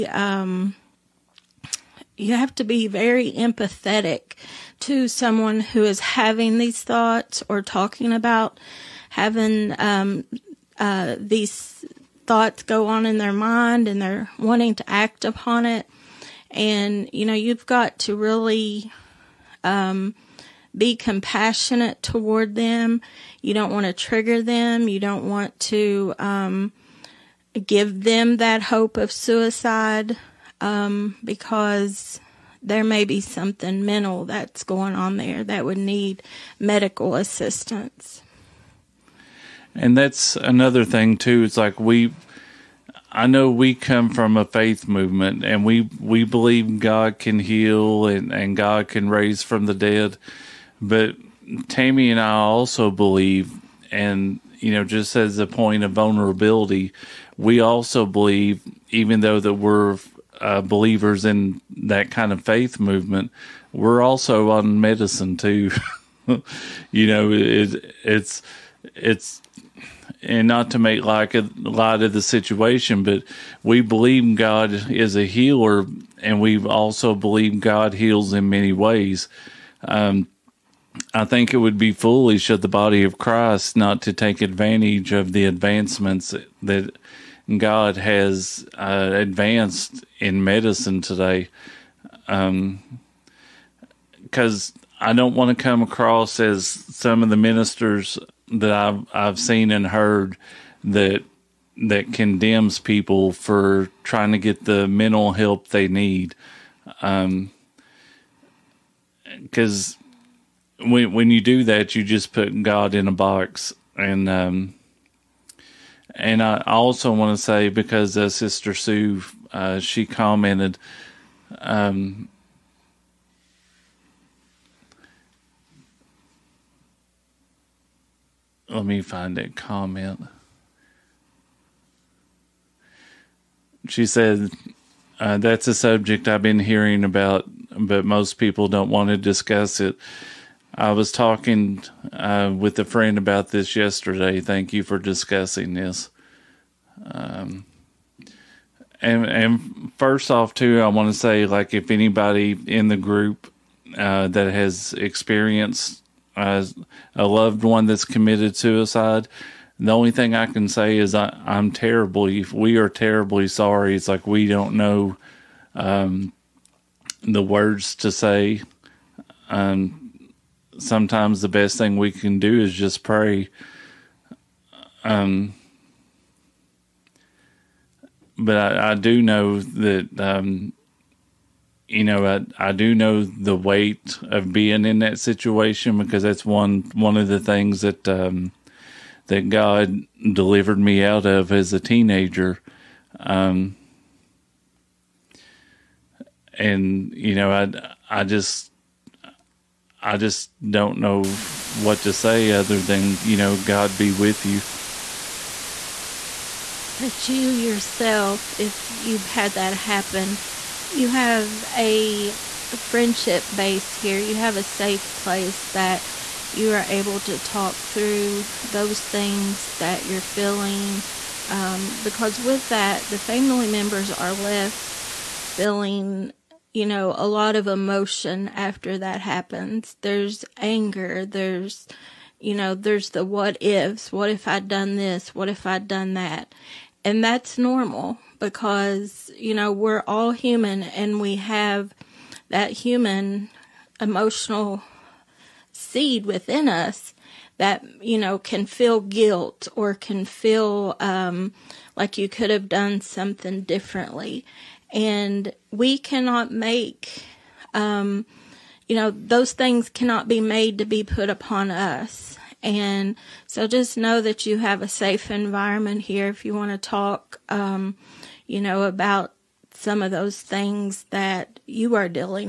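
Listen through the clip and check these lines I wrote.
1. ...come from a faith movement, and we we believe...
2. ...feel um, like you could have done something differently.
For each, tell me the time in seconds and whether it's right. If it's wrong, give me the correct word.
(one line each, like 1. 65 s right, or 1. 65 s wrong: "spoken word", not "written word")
1. 43 s right
2. 250 s right.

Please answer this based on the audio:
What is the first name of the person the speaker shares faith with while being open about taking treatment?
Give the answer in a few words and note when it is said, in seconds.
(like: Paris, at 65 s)
Tammy, at 51 s.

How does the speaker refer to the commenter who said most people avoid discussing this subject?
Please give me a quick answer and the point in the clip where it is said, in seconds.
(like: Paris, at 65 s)
Sister Sue, at 118 s.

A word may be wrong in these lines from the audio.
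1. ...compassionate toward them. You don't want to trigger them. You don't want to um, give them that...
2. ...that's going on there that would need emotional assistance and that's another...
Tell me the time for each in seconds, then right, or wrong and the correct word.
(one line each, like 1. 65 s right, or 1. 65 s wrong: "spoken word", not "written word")
1. 20 s right
2. 34 s wrong: "medical", not "emotional".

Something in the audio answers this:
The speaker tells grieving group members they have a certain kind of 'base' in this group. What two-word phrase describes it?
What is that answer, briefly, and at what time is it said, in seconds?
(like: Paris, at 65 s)
friendship base, at 212 s.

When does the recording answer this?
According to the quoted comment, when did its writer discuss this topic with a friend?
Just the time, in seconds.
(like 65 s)
143 s.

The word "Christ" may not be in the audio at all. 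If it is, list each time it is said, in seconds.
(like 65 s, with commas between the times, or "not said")
83 s.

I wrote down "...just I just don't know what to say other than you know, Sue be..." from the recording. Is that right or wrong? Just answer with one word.
wrong.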